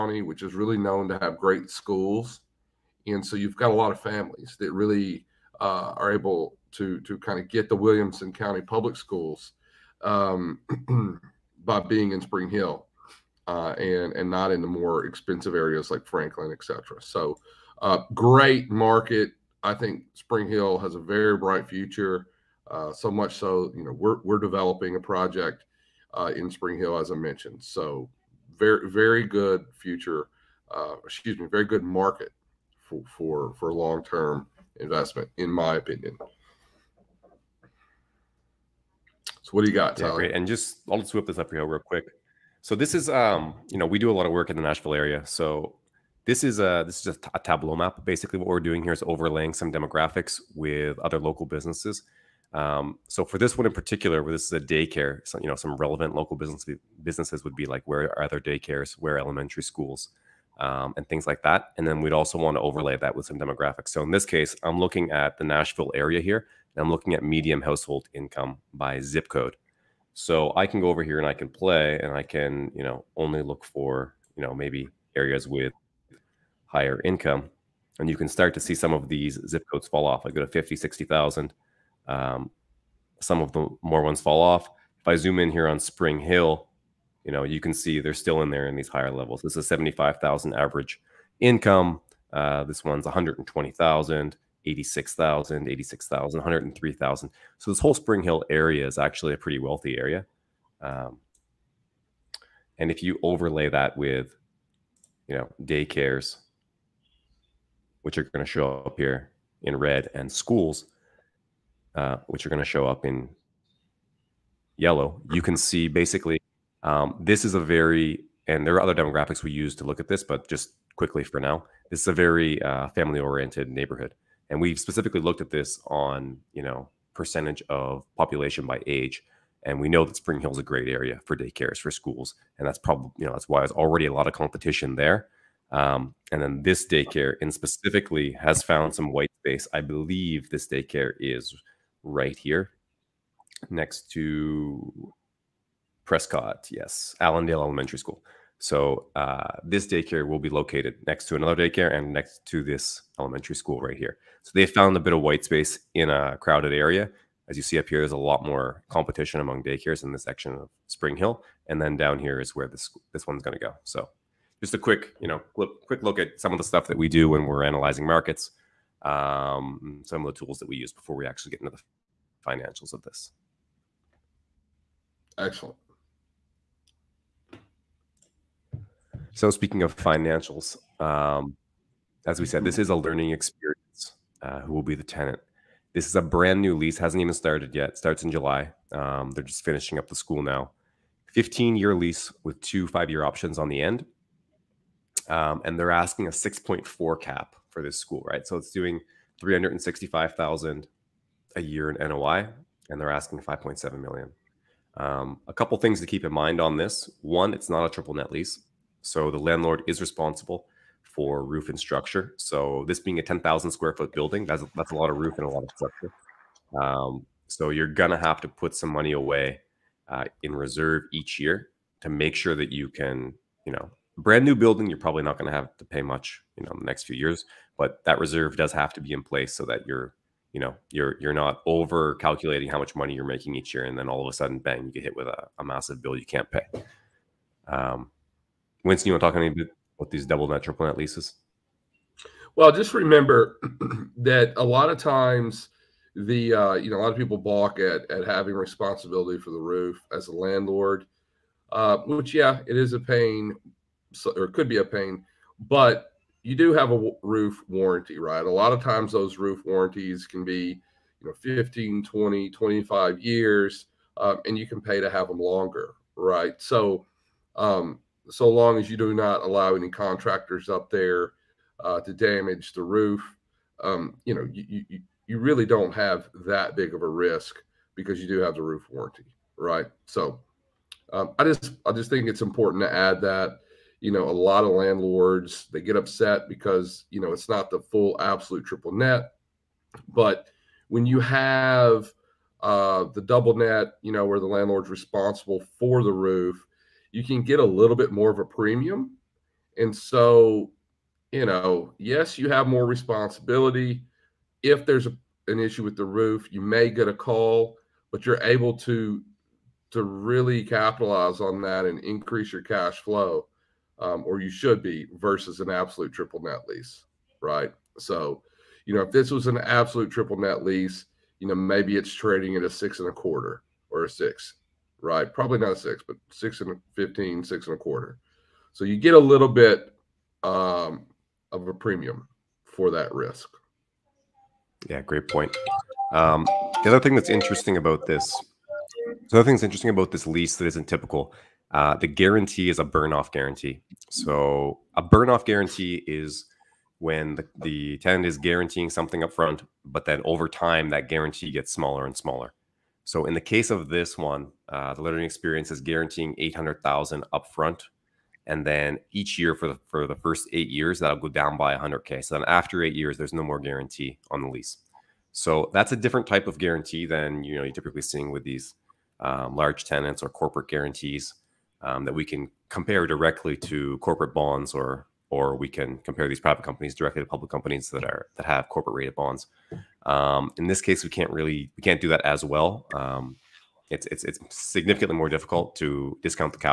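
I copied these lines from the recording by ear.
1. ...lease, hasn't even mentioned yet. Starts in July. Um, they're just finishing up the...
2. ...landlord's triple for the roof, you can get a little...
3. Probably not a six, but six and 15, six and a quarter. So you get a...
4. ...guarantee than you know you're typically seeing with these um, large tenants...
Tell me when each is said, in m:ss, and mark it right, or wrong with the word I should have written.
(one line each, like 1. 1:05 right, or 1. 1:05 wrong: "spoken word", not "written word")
1. 3:06 wrong: "started", not "mentioned"
2. 4:54 wrong: "responsible", not "triple"
3. 5:25 right
4. 6:06 right.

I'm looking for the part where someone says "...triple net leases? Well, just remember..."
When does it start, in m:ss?
4:00.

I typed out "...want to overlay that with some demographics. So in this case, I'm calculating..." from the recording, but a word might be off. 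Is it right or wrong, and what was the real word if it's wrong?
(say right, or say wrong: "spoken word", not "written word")
wrong: "looking", not "calculating".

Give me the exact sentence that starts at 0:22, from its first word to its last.
Uh, so much so, you know, we're, we're developing a project uh, in Spring Hill, as I mentioned.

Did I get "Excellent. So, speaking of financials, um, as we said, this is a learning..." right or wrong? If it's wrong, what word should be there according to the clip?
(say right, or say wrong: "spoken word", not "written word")
right.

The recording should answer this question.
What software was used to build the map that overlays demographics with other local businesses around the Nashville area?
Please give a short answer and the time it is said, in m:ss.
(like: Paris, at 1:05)
Tableau, at 0:47.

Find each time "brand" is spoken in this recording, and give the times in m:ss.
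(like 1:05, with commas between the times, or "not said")
3:06, 3:44.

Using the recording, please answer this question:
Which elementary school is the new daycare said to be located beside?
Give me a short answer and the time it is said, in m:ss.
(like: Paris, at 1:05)
Allendale Elementary School, at 2:27.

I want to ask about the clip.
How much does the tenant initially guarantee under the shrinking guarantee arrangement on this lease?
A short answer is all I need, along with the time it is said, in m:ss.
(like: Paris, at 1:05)
800,000, at 5:56.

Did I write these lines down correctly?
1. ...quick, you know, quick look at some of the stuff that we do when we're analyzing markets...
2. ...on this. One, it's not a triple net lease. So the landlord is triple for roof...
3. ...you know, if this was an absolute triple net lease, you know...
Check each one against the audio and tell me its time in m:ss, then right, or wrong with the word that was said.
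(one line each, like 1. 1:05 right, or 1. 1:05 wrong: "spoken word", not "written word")
1. 2:44 right
2. 3:26 wrong: "responsible", not "triple"
3. 5:18 right.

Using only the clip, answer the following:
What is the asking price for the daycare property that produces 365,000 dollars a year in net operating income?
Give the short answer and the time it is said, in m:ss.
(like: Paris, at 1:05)
5.7 million, at 3:23.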